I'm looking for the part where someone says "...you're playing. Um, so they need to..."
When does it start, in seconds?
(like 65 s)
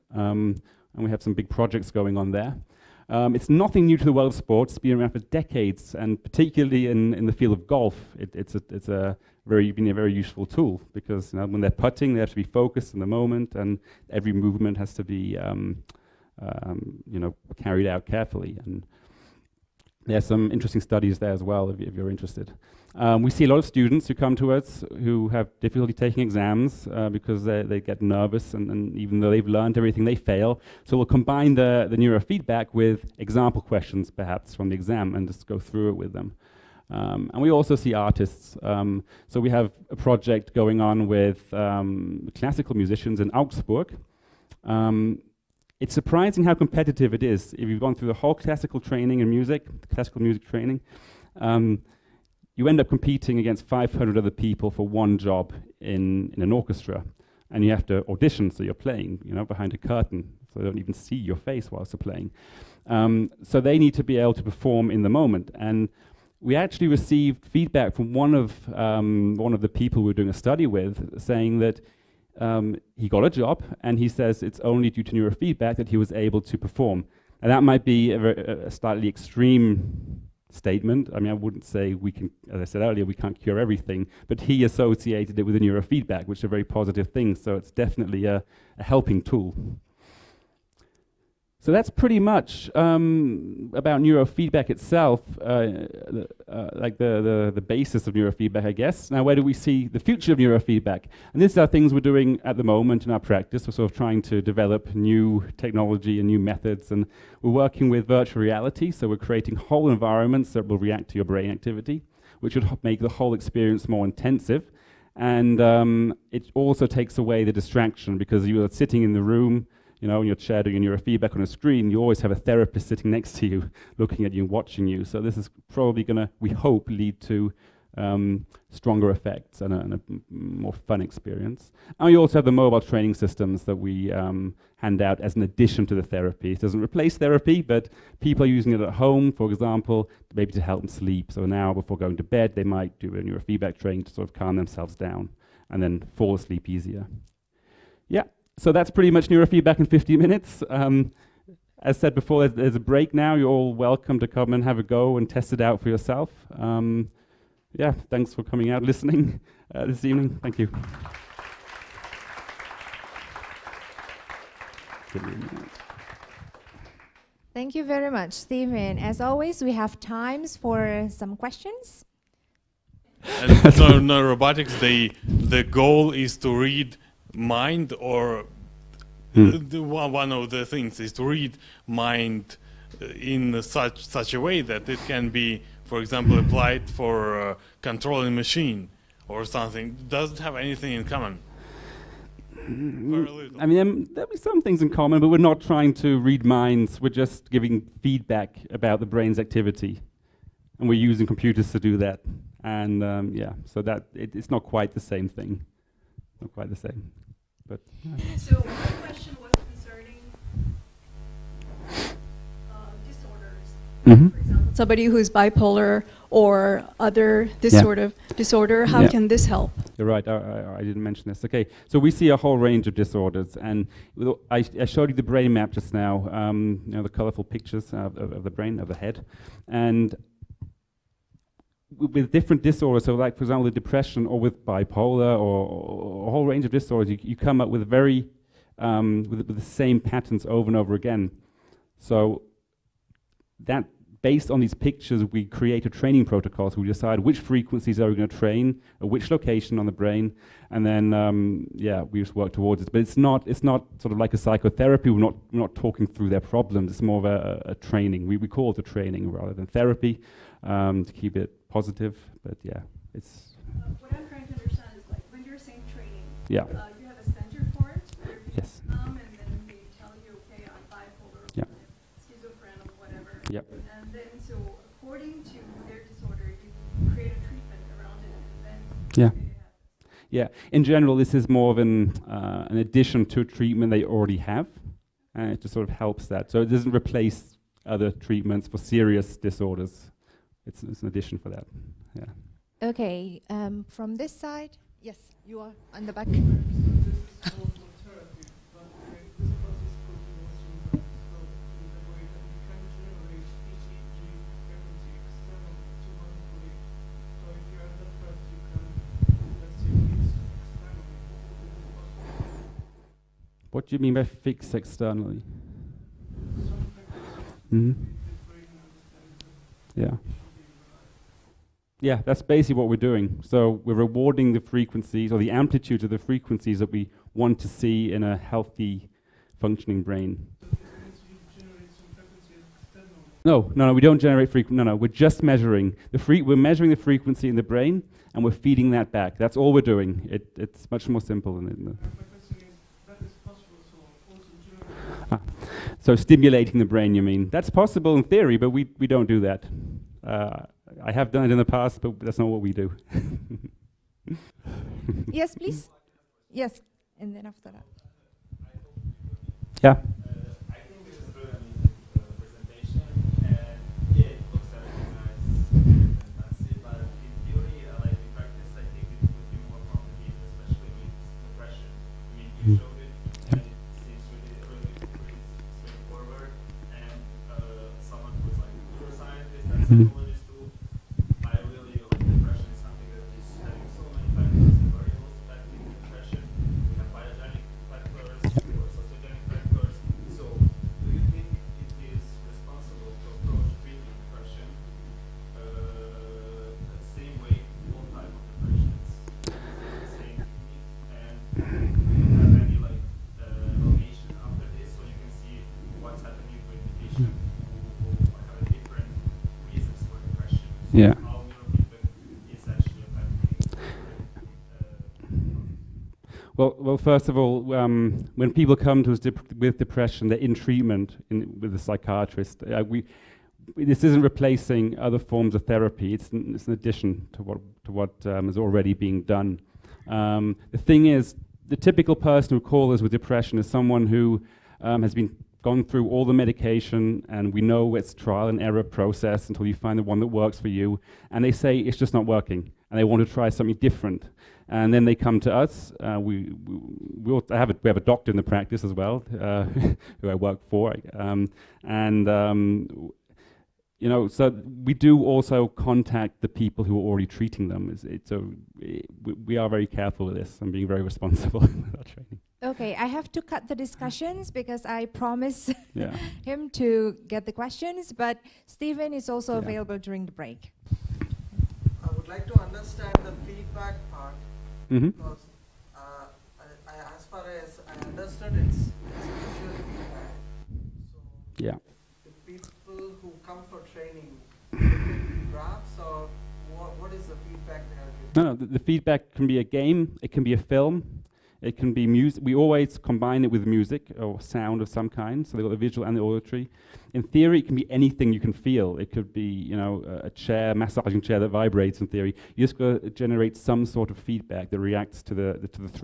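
61 s.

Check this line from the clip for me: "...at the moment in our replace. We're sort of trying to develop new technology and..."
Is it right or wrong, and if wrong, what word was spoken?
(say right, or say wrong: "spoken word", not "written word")
wrong: "practice", not "replace".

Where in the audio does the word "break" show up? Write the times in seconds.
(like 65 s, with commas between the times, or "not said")
152 s, 470 s.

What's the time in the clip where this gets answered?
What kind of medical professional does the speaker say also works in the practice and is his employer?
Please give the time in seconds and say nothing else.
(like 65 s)
447 s.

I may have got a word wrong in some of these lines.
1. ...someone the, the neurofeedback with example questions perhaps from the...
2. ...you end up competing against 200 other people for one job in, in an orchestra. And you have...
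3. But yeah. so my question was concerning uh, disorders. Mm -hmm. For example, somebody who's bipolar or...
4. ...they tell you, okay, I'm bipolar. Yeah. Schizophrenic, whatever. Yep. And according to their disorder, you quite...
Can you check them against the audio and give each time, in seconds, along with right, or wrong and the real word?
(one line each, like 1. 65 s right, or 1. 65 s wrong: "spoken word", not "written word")
1. 31 s wrong: "combine", not "someone"
2. 52 s wrong: "500", not "200"
3. 207 s right
4. 269 s wrong: "create", not "quite".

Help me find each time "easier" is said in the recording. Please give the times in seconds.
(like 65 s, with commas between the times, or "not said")
146 s.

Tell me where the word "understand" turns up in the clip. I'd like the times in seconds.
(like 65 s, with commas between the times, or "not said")
264 s, 472 s.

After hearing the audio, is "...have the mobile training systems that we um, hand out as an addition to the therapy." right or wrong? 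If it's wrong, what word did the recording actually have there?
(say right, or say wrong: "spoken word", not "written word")
right.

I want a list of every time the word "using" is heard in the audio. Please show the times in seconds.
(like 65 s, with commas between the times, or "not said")
138 s, 201 s.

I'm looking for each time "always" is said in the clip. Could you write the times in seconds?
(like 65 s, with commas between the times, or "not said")
121 s, 169 s, 492 s.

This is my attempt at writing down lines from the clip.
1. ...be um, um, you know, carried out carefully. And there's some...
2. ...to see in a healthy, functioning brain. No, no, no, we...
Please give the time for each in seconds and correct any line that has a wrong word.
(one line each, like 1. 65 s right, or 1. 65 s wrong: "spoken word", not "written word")
1. 15 s right
2. 327 s right.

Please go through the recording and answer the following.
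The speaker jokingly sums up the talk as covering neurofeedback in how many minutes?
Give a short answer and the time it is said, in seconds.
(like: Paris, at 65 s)
50, at 149 s.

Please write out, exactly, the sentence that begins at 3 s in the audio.
Um, it's nothing new to the world of sports.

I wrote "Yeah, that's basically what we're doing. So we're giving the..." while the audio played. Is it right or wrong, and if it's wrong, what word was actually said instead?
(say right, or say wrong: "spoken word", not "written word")
wrong: "rewarding", not "giving".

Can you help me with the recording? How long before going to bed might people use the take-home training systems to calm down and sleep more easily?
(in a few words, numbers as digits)
An hour.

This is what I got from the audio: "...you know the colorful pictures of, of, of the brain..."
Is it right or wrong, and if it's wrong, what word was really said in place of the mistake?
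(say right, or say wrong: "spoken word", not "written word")
right.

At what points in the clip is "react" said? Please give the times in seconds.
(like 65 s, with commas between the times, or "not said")
110 s, 504 s.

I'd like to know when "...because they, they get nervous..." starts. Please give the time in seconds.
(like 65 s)
27 s.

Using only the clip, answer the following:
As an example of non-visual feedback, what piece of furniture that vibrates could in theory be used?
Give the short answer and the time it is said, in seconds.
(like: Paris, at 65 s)
Massaging chair, at 500 s.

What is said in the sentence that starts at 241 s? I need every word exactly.
So that based on these pictures, we create a training protocol.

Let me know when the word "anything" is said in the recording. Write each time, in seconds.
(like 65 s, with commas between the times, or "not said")
190 s, 497 s.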